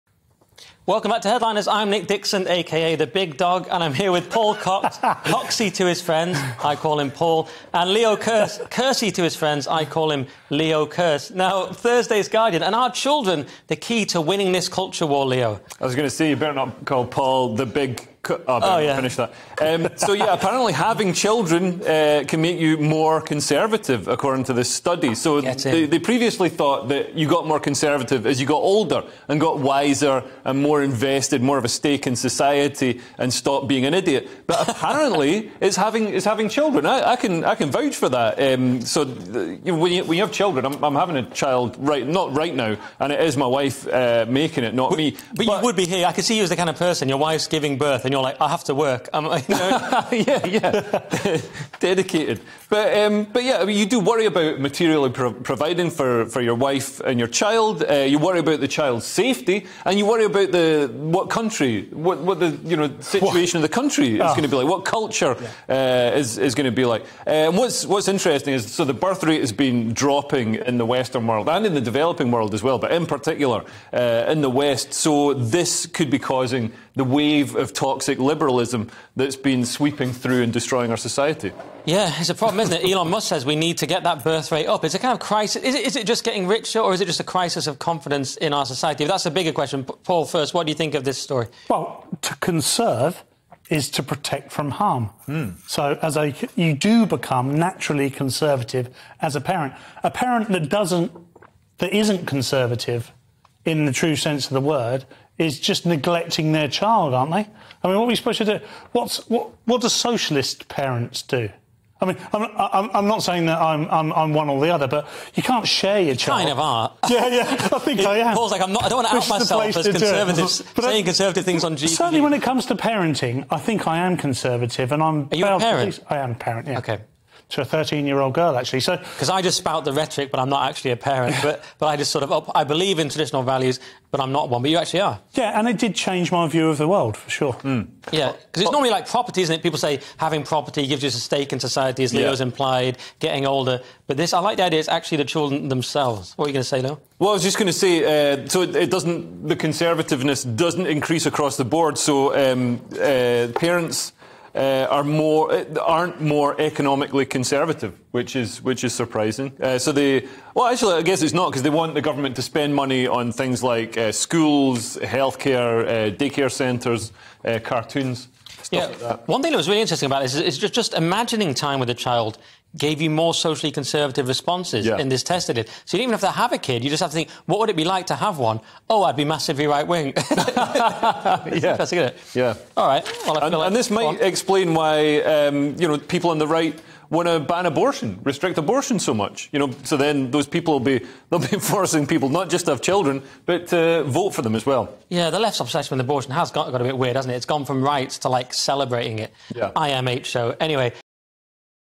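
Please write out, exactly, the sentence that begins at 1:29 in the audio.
Paul, first, what do you think of this story?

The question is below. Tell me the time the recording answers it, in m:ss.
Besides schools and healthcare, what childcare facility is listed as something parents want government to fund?
2:46.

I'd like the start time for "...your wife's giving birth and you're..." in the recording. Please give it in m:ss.
0:47.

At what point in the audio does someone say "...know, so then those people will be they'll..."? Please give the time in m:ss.
3:09.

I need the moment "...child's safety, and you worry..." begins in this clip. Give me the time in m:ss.
0:58.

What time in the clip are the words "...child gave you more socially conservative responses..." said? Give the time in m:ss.
2:51.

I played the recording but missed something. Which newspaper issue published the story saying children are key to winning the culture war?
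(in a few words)
Thursday's Guardian.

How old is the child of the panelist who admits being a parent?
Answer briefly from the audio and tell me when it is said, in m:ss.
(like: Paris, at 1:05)
13, at 2:07.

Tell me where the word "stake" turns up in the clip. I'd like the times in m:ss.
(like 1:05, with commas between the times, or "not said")
0:31, 2:21.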